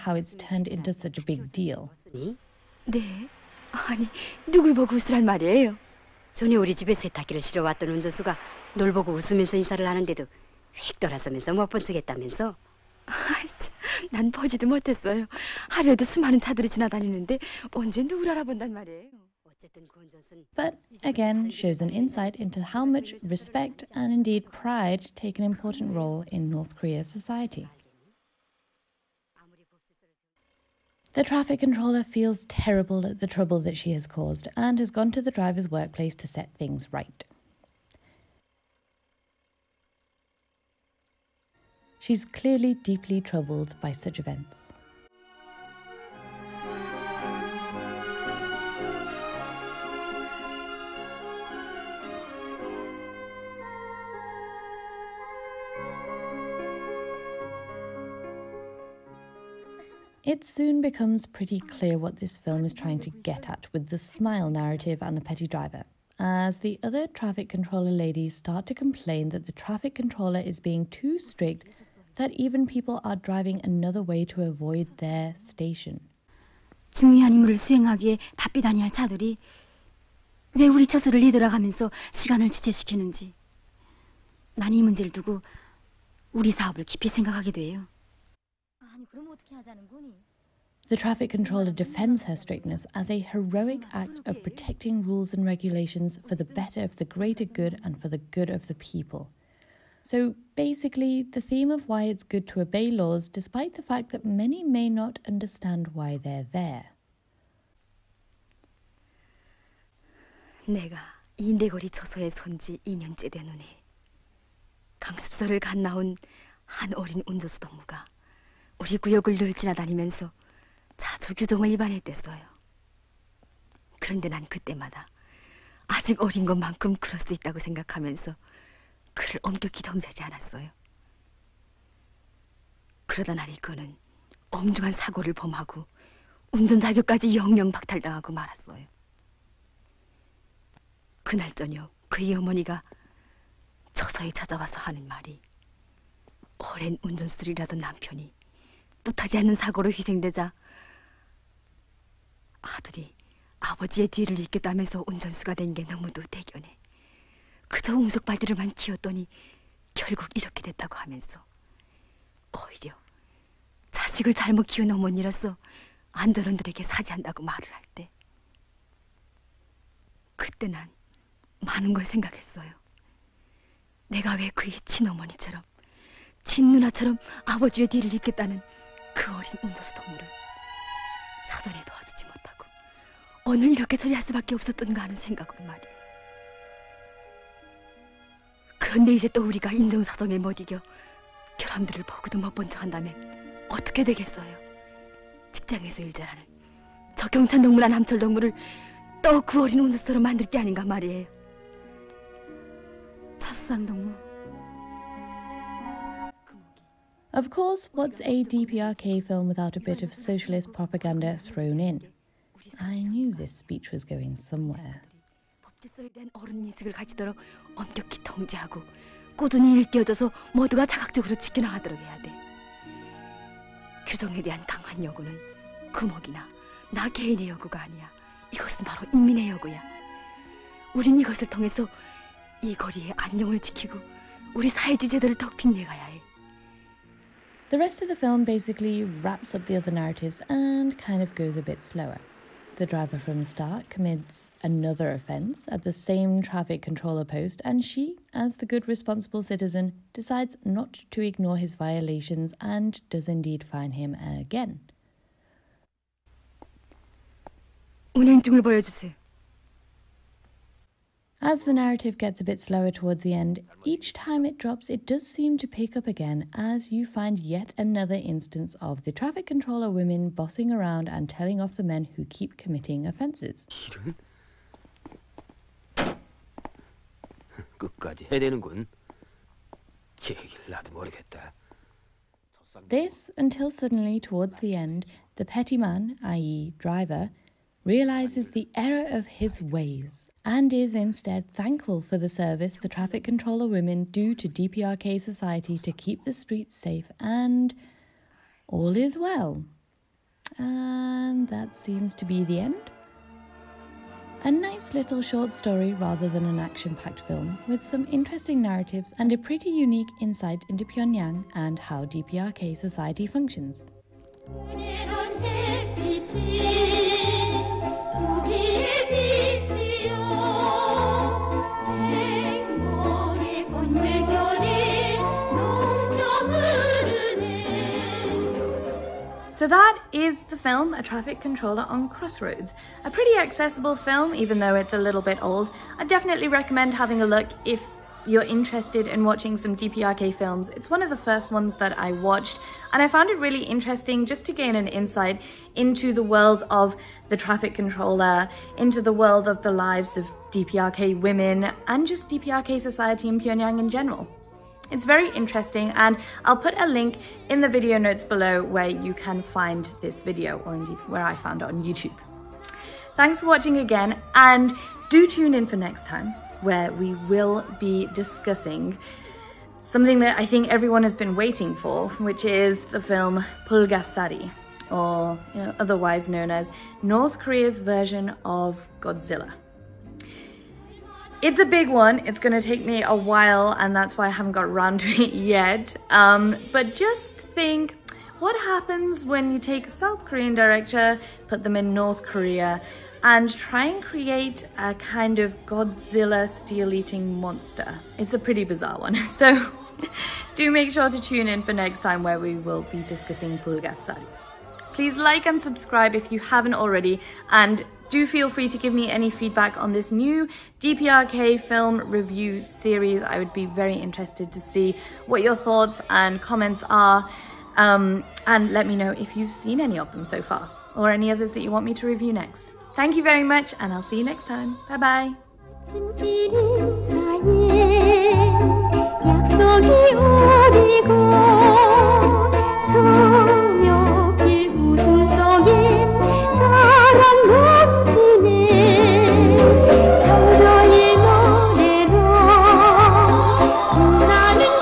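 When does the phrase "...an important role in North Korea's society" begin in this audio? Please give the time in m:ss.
0:25.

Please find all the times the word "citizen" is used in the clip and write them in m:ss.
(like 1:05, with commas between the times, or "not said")
4:09.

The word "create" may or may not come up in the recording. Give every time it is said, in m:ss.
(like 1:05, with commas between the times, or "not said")
6:34.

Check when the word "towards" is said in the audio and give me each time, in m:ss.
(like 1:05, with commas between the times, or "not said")
4:22, 4:44.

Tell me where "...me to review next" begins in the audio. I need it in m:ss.
7:01.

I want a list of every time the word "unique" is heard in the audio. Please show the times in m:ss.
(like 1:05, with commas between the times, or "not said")
5:09.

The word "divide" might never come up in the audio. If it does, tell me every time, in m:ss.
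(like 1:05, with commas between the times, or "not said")
not said.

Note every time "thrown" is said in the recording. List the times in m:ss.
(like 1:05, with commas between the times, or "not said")
3:31.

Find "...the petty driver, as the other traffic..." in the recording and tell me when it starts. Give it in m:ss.
1:05.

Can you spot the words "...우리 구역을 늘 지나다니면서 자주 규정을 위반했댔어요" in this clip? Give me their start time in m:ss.
1:58.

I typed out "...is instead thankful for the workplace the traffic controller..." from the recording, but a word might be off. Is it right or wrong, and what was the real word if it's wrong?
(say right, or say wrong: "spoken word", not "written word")
wrong: "service", not "workplace".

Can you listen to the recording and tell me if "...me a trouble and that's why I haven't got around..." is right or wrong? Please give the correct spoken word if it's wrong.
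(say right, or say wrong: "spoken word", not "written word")
wrong: "while", not "trouble".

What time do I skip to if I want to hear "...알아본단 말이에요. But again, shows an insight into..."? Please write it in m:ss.
0:18.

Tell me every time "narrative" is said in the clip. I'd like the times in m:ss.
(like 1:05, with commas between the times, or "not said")
1:04, 3:59, 4:21, 5:08.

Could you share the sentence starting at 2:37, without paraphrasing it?
그저 옹석발들을만 키웠더니 결국 이렇게 됐다고 하면서 오히려 자식을 잘못 키운 어머니라서 안전원들에게 사죄한다고 말을 할 때 그때 난 많은 걸 생각했어요.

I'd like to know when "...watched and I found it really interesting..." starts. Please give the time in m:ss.
5:42.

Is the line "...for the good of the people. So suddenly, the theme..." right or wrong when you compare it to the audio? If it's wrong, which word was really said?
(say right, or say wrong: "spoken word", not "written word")
wrong: "basically", not "suddenly".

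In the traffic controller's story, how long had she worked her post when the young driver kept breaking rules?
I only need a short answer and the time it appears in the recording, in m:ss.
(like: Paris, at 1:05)
2 years, at 1:52.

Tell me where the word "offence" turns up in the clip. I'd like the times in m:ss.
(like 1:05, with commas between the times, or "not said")
4:05, 4:33.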